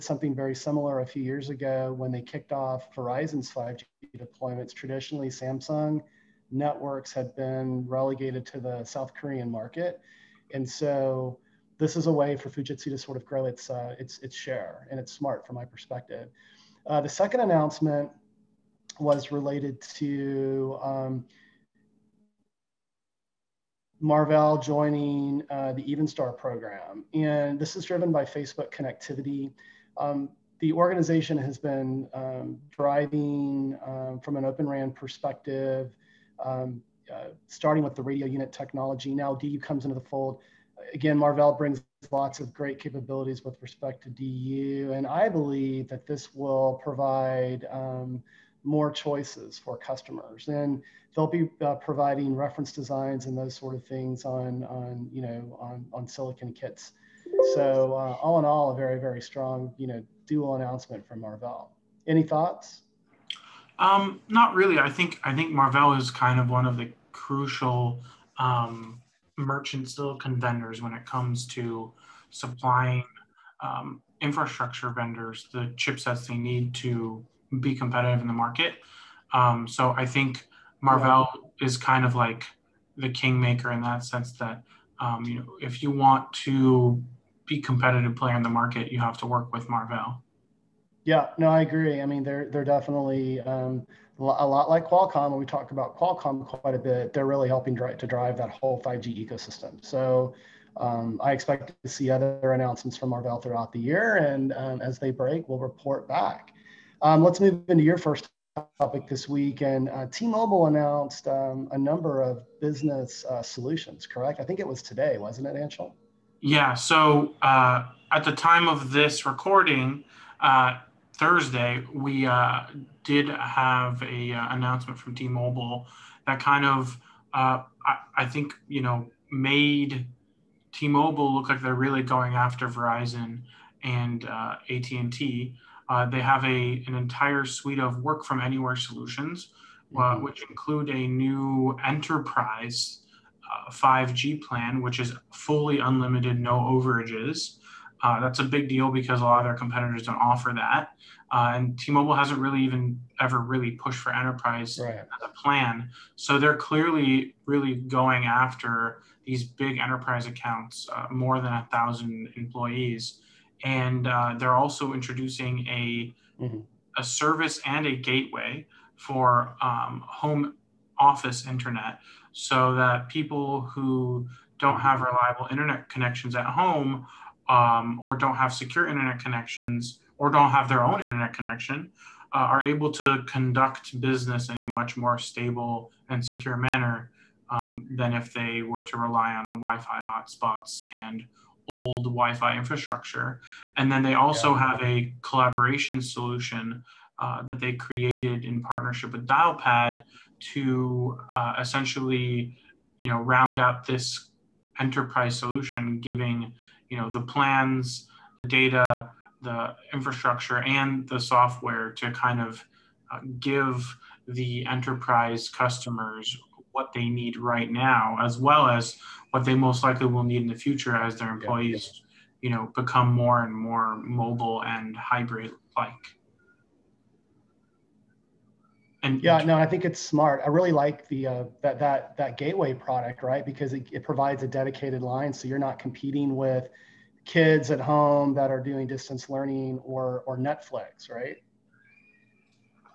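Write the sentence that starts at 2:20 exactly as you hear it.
which include a new enterprise 5G uh, plan, which is fully unlimited, no overages.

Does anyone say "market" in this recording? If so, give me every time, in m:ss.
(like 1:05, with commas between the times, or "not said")
0:09, 1:18, 1:28.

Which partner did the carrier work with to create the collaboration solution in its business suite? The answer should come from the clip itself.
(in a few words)
Dialpad.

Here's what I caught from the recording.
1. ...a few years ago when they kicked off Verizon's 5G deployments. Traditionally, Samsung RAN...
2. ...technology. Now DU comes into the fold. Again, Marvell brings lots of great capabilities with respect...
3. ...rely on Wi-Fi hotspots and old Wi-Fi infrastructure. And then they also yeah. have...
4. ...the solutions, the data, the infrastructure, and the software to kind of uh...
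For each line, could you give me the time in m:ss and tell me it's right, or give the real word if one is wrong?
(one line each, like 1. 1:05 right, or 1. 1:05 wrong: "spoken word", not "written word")
1. 0:01 wrong: "Networks", not "RAN"
2. 0:38 right
3. 3:08 right
4. 3:27 wrong: "plans", not "solutions".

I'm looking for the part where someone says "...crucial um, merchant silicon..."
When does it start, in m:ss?
1:07.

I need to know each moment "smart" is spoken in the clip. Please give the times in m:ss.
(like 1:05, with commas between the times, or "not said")
0:15, 3:49.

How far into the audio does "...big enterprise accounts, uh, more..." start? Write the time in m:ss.
2:39.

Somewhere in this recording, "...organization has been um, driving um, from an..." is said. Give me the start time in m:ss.
0:30.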